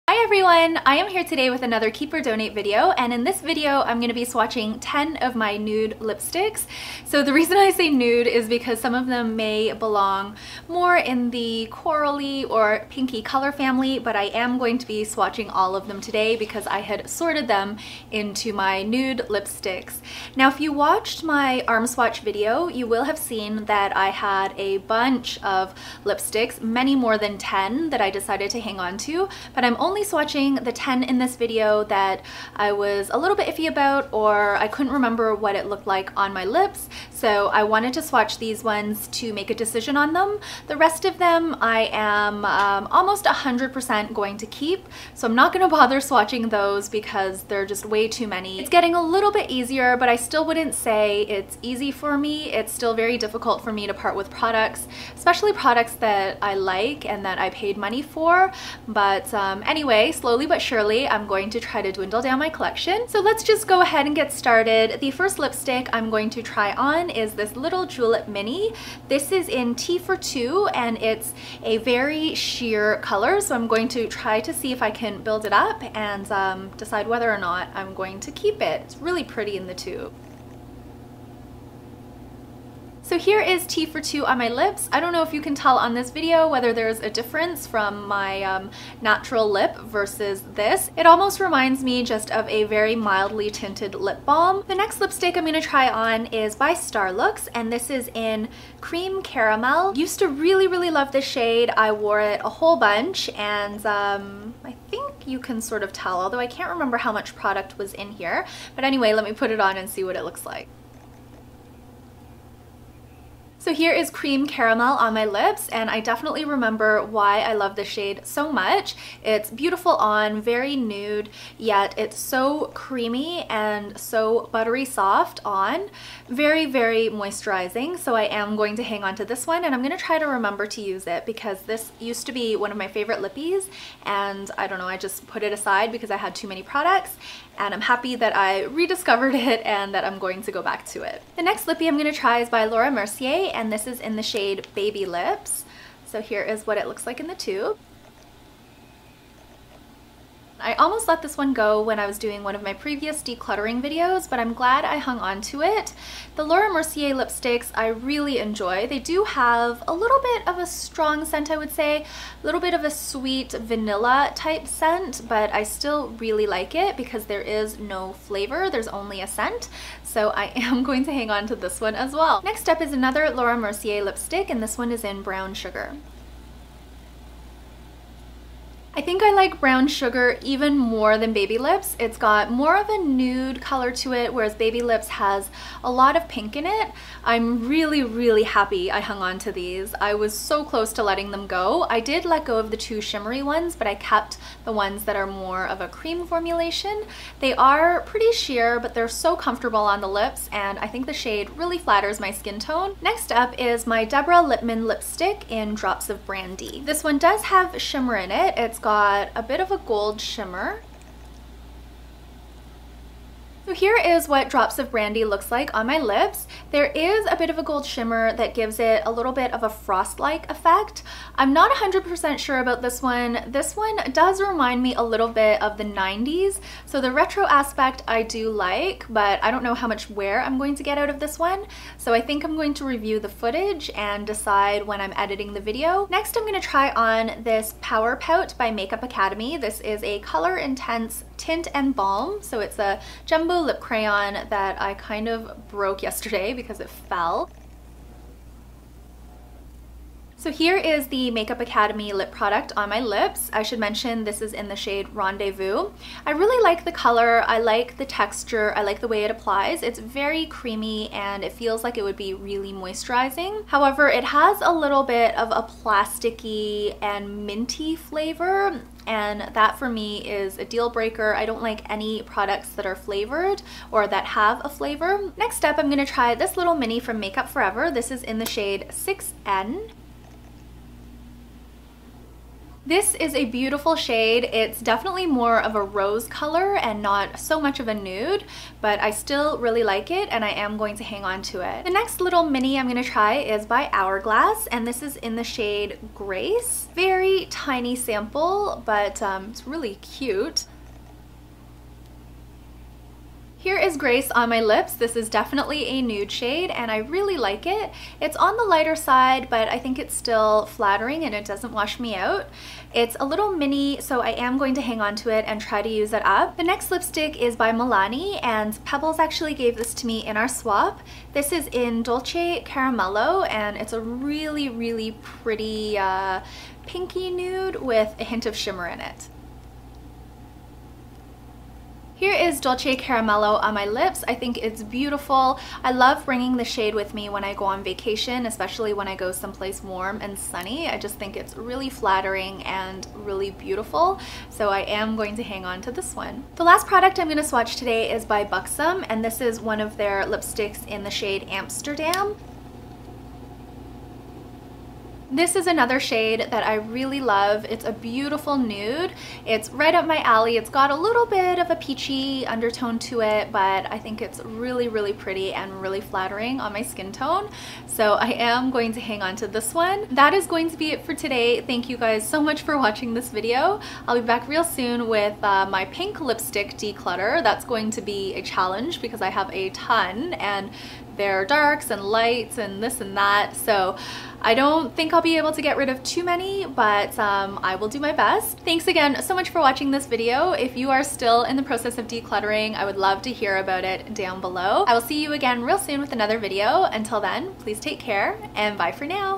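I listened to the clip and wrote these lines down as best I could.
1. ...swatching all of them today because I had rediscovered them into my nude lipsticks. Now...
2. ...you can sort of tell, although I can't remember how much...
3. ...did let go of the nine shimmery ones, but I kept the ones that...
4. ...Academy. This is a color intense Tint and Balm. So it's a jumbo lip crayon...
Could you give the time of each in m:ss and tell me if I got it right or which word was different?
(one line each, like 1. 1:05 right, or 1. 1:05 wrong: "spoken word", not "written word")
1. 0:15 wrong: "sorted", not "rediscovered"
2. 1:45 right
3. 3:12 wrong: "two", not "nine"
4. 3:59 right.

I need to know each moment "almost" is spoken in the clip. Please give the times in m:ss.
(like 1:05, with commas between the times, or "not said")
0:42, 1:31, 2:30.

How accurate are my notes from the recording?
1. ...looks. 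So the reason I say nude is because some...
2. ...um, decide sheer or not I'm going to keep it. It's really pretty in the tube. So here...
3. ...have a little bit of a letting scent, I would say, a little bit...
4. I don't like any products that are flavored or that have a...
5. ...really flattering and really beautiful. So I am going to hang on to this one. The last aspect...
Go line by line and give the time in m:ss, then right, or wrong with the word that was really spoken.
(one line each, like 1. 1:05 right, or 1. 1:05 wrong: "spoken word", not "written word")
1. 0:05 wrong: "lipsticks", not "looks"
2. 1:16 wrong: "whether", not "sheer"
3. 2:39 wrong: "strong", not "letting"
4. 4:31 right
5. 5:41 wrong: "product", not "aspect".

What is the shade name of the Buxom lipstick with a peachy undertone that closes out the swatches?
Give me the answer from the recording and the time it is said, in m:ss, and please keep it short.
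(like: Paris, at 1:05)
Amsterdam, at 5:51.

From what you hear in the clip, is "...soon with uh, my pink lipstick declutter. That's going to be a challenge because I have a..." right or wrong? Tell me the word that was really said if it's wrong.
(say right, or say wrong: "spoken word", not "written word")
right.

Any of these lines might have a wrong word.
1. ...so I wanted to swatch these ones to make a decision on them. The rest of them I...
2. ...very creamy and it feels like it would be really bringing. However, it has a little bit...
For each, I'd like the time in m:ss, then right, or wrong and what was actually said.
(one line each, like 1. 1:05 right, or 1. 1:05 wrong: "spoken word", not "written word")
1. 0:37 right
2. 4:19 wrong: "moisturizing", not "bringing".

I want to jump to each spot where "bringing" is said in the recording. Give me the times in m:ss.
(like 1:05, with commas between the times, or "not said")
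5:36.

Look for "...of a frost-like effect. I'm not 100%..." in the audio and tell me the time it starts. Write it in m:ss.
3:39.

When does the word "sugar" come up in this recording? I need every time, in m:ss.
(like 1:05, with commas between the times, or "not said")
2:55, 2:59.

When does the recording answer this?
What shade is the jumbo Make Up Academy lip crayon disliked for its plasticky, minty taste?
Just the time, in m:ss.
4:15.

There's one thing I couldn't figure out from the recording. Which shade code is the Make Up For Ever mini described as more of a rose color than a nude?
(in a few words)
6N.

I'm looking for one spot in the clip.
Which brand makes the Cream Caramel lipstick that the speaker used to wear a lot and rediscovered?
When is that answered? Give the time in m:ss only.
1:36.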